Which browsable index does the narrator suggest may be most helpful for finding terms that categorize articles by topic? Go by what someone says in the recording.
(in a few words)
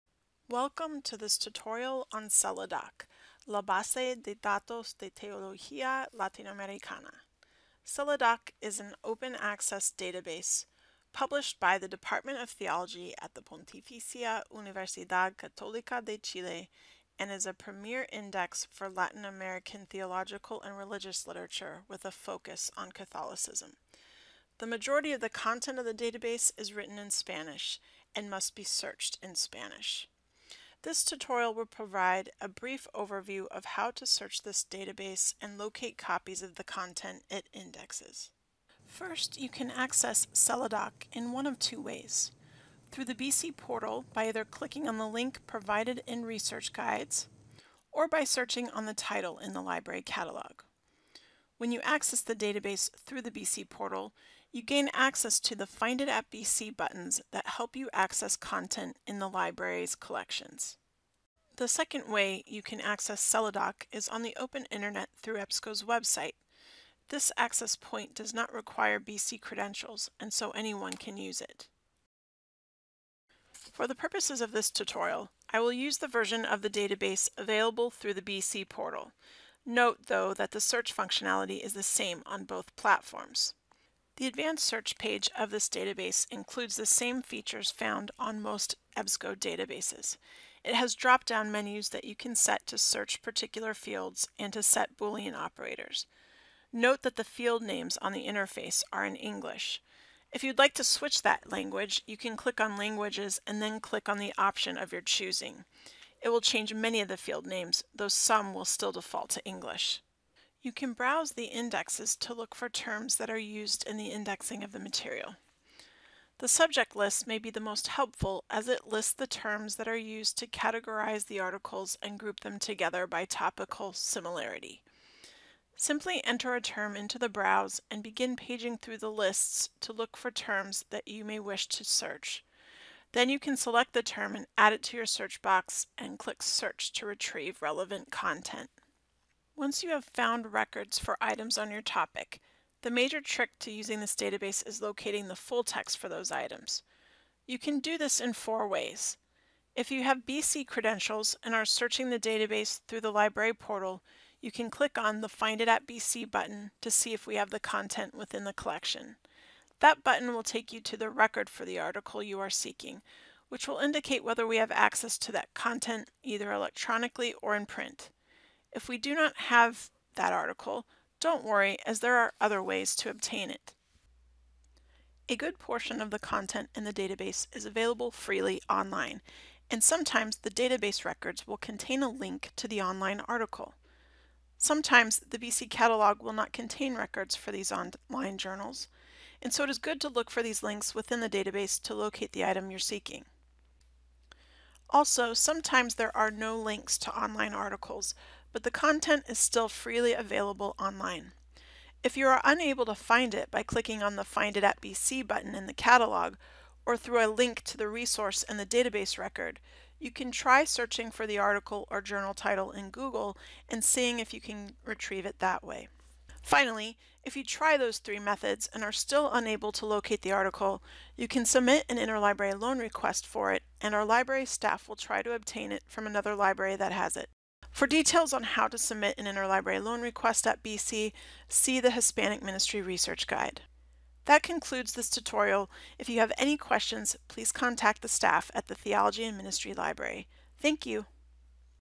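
subject list.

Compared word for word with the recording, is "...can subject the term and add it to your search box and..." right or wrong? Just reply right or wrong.
wrong.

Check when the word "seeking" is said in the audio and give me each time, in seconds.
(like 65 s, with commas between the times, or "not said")
162 s, 192 s.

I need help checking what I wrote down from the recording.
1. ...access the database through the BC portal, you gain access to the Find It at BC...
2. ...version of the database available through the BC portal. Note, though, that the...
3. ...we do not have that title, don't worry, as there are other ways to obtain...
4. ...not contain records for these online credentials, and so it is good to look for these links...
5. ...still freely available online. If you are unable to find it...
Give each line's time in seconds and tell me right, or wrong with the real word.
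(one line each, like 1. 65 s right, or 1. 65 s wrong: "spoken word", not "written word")
1. 51 s right
2. 76 s right
3. 168 s wrong: "article", not "title"
4. 186 s wrong: "journals", not "credentials"
5. 199 s right.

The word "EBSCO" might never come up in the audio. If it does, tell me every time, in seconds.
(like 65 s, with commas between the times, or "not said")
65 s, 88 s.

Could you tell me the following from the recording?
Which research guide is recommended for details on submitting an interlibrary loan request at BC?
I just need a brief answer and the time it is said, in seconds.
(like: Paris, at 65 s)
Hispanic Ministry Research Guide, at 231 s.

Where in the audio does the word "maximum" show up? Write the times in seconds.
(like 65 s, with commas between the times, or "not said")
not said.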